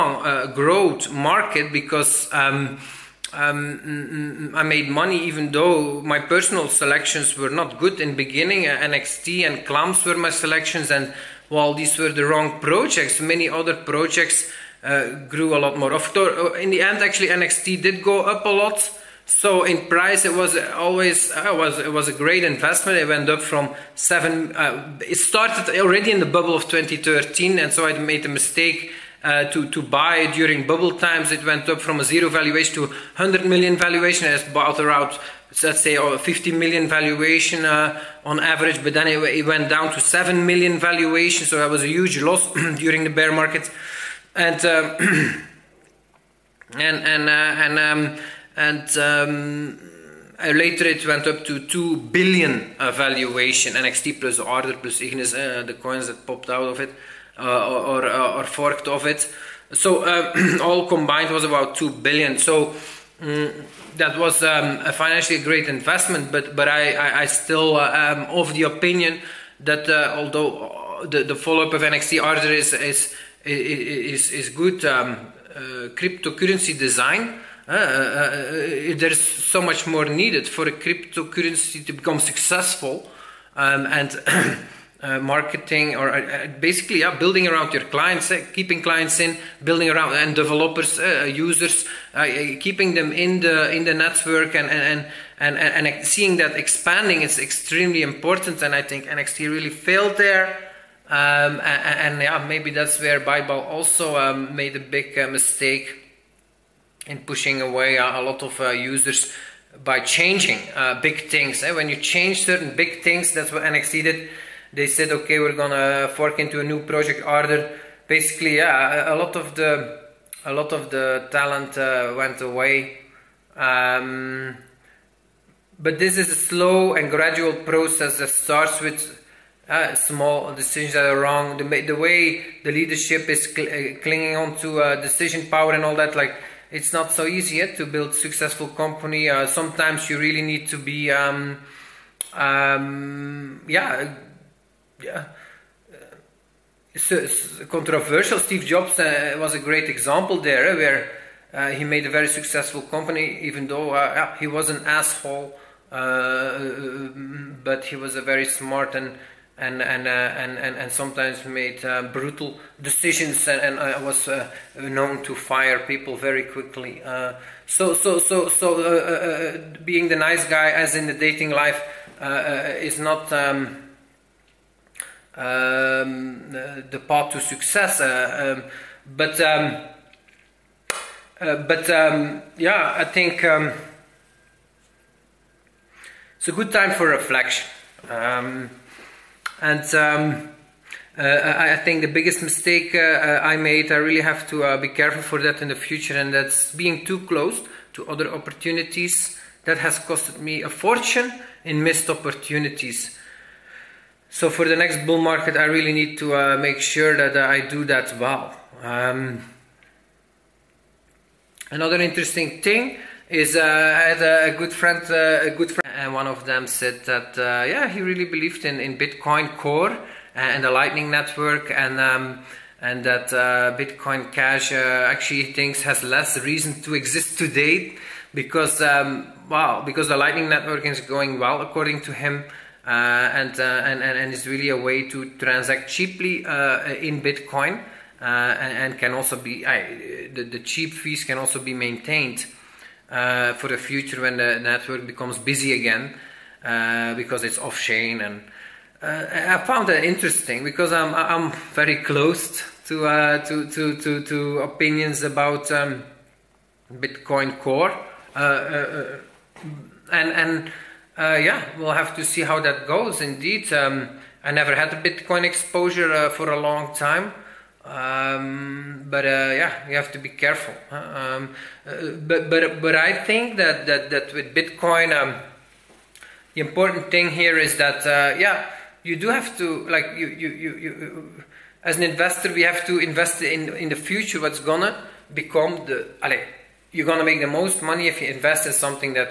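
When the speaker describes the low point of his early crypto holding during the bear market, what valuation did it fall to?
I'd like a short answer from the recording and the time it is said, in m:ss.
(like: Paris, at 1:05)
7 million, at 0:40.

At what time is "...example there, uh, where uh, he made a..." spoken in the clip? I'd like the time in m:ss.
2:29.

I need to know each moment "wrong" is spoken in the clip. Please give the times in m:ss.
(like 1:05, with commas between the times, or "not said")
0:12, 2:11.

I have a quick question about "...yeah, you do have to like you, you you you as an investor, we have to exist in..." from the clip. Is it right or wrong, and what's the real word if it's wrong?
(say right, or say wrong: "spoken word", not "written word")
wrong: "invest", not "exist".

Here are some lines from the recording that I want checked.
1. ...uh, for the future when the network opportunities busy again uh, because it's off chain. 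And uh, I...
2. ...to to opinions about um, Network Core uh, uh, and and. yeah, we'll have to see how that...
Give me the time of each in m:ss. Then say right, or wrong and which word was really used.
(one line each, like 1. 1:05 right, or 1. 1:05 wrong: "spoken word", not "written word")
1. 4:03 wrong: "becomes", not "opportunities"
2. 4:14 wrong: "Bitcoin", not "Network".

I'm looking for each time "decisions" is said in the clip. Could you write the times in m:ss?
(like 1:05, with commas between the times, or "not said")
2:10, 2:15, 2:42.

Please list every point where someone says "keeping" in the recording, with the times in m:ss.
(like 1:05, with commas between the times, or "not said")
1:28, 1:32.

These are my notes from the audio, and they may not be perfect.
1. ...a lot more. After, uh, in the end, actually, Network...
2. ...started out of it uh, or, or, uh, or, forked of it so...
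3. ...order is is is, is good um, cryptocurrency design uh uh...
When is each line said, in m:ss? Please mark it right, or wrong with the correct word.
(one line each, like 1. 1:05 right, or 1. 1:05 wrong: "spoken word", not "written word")
1. 0:15 wrong: "NXT", not "Network"
2. 0:56 wrong: "popped", not "started"
3. 1:12 right.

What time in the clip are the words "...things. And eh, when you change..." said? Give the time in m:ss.
1:51.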